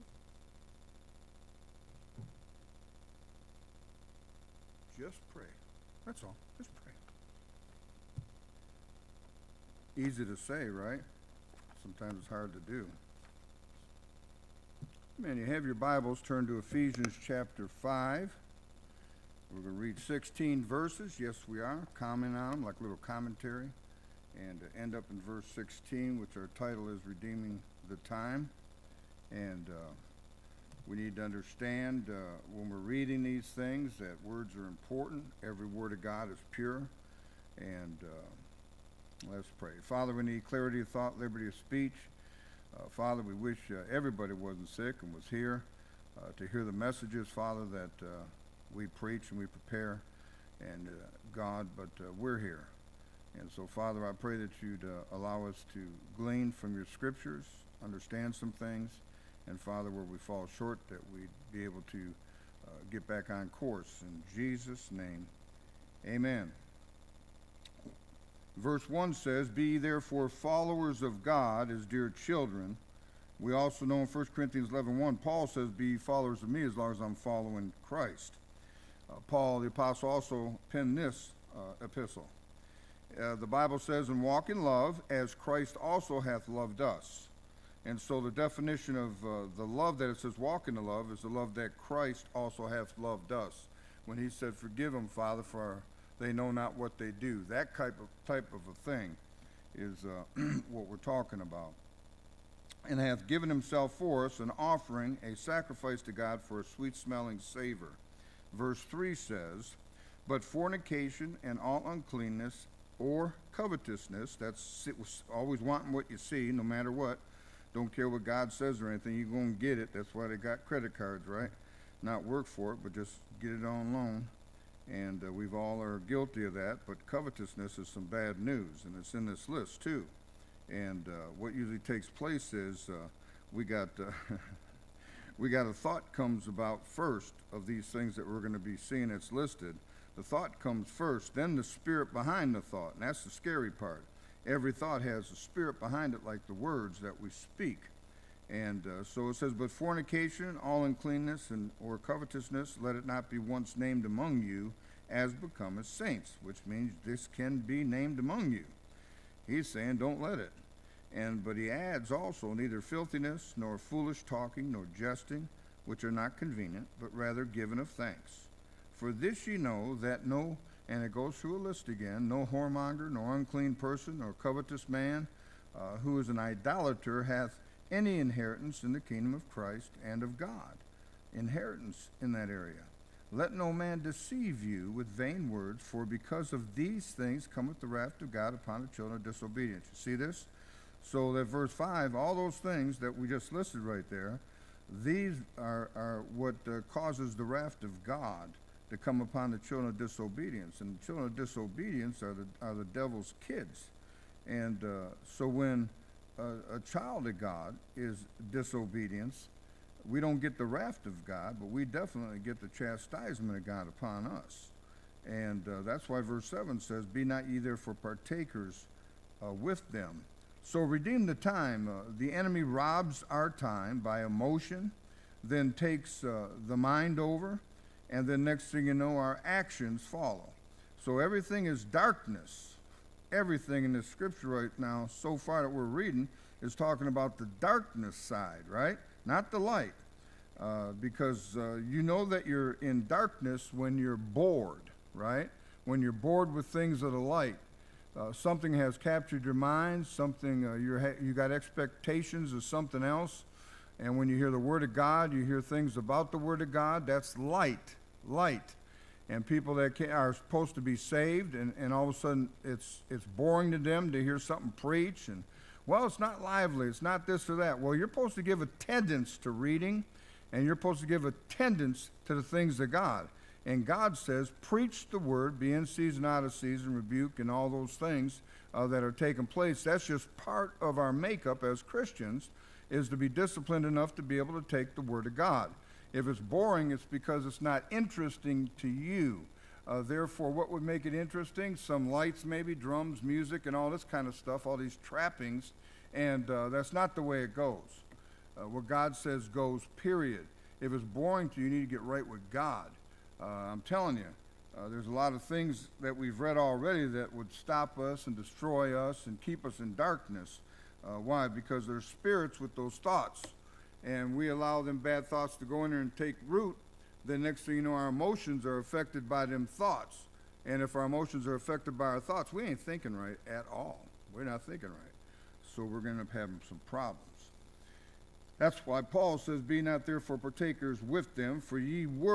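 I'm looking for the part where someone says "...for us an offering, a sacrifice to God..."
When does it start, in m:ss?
1:43.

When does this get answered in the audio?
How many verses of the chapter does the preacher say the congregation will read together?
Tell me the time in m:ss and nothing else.
0:19.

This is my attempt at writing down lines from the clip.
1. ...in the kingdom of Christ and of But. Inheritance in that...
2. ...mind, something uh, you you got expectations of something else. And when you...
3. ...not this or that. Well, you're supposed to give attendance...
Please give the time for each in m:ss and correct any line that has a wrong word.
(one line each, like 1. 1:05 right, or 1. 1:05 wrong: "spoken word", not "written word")
1. 2:58 wrong: "God", not "But"
2. 4:09 right
3. 4:27 right.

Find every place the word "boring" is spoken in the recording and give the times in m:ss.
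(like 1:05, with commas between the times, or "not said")
4:23, 4:46, 5:01.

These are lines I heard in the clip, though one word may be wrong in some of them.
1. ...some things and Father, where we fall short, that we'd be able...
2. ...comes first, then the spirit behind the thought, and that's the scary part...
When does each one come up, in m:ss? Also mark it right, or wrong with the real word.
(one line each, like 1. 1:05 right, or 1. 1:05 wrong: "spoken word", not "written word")
1. 0:58 right
2. 2:20 right.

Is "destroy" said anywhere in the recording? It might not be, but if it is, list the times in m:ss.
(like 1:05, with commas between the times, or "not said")
5:08.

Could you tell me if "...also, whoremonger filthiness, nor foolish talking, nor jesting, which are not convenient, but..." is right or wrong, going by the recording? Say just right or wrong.
wrong.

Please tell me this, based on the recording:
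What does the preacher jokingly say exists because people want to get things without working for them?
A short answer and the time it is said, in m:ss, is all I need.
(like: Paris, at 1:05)
credit cards, at 2:00.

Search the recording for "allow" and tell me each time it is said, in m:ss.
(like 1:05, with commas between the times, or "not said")
0:55, 5:14.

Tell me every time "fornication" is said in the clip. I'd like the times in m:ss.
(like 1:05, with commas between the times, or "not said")
1:50, 2:29.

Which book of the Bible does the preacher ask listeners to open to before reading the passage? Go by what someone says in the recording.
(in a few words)
Ephesians.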